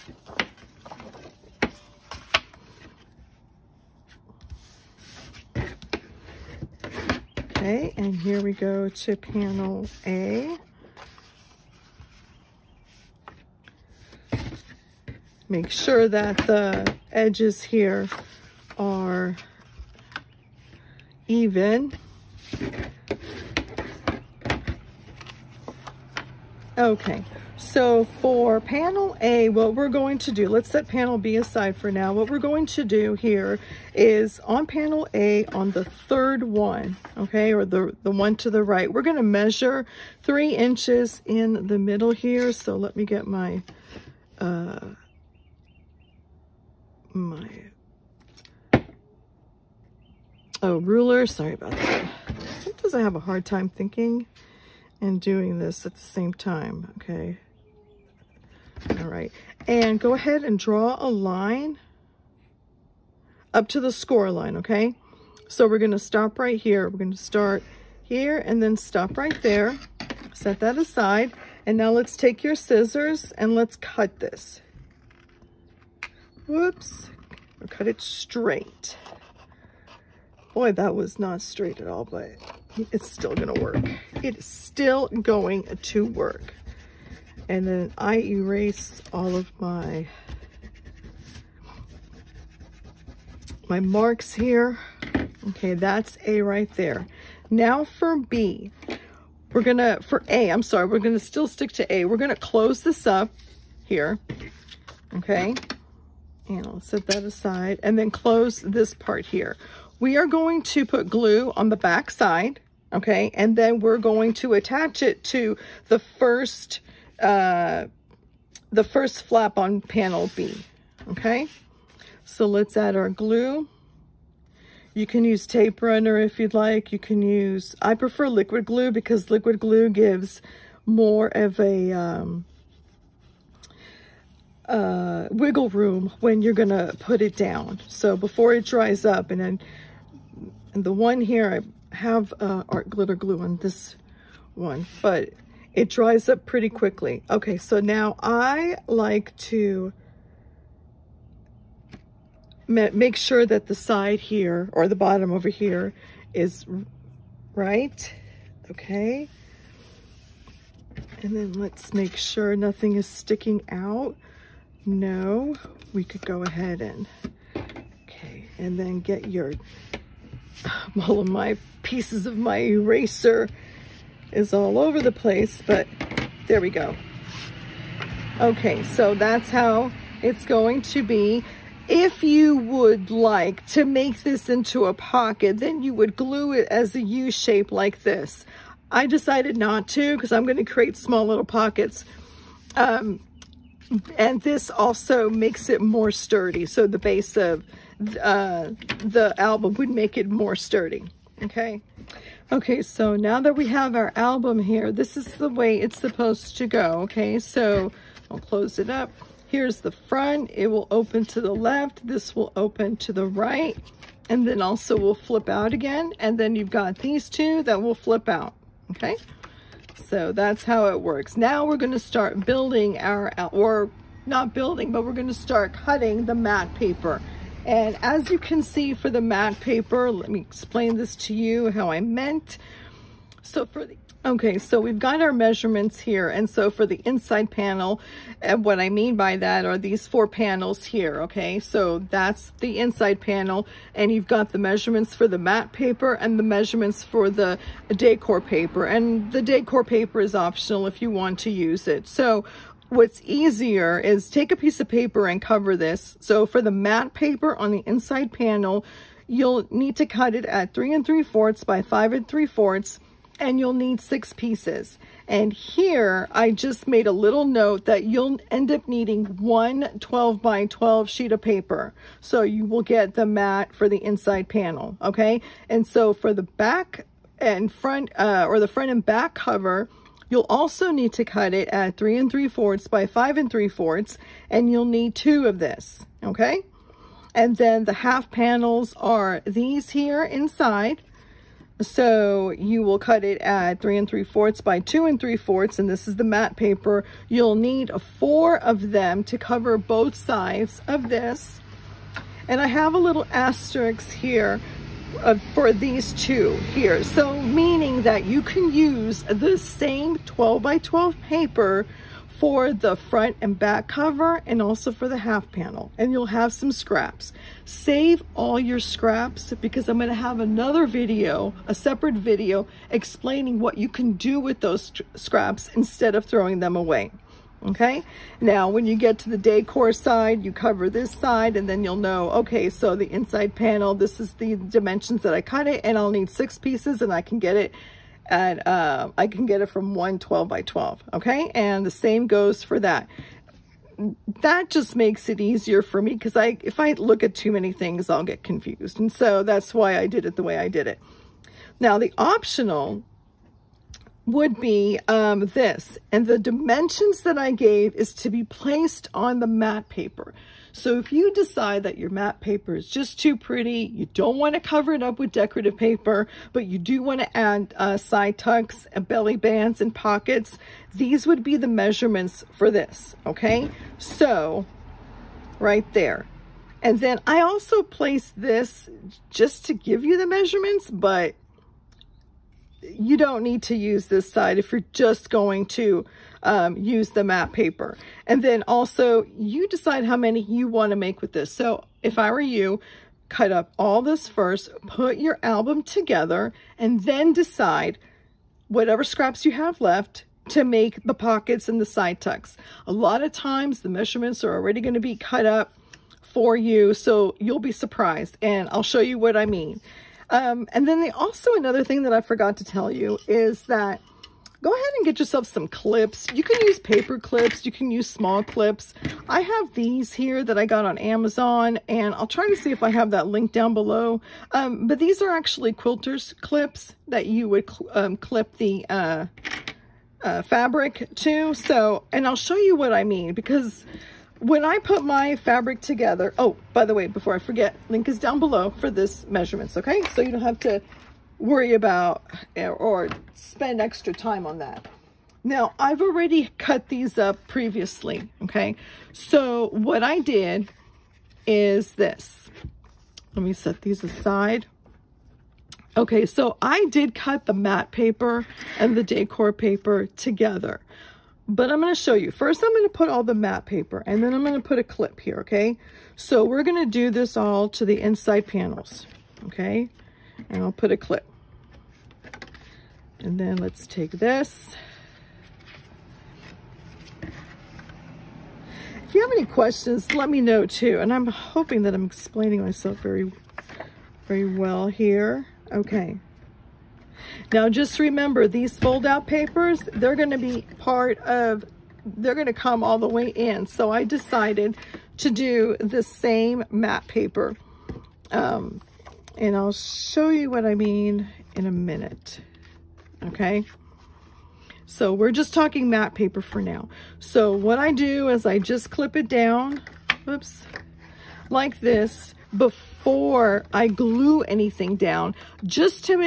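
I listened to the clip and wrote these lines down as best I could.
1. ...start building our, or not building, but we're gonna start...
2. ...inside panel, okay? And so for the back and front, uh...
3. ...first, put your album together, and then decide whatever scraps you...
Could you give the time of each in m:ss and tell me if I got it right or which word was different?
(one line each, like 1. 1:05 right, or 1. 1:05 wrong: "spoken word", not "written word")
1. 3:41 right
2. 4:34 right
3. 6:34 right.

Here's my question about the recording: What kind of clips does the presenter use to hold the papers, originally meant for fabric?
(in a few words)
Quilter's clips.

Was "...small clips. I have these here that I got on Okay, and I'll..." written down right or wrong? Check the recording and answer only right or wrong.
wrong.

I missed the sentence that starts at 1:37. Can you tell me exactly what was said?
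Now for B, we're gonna, for A, I'm sorry, we're gonna still stick to A.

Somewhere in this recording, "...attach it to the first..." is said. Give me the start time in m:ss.
1:54.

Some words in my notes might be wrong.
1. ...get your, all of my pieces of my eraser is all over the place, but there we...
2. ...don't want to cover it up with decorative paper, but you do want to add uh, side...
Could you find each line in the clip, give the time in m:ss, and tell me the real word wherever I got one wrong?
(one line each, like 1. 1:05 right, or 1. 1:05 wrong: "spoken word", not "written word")
1. 2:48 right
2. 6:04 right.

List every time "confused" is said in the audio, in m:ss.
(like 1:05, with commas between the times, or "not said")
5:48.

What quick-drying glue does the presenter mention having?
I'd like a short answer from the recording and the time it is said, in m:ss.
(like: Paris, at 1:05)
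Art glitter glue, at 2:22.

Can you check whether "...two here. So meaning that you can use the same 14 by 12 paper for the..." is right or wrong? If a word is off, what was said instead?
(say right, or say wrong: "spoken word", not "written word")
wrong: "12", not "14".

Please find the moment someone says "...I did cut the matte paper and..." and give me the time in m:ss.
7:36.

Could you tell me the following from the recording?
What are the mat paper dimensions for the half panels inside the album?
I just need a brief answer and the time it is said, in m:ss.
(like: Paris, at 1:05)
3 3/4 by 2 3/4, at 4:53.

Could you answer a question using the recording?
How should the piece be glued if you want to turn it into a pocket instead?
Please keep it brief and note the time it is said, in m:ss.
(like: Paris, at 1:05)
As a U shape, at 3:06.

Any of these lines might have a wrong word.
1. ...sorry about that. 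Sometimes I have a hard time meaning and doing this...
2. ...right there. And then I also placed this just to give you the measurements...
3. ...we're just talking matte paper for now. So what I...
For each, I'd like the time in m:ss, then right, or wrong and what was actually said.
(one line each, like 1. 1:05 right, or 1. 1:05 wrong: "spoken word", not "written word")
1. 0:51 wrong: "thinking", not "meaning"
2. 6:15 right
3. 8:25 right.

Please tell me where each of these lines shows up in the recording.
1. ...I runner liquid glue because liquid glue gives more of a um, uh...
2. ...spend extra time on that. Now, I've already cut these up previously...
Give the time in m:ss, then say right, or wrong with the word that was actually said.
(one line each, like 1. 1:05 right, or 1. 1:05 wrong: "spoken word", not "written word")
1. 2:07 wrong: "prefer", not "runner"
2. 7:23 right.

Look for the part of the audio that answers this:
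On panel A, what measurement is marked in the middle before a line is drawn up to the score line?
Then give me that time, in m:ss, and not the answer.
0:40.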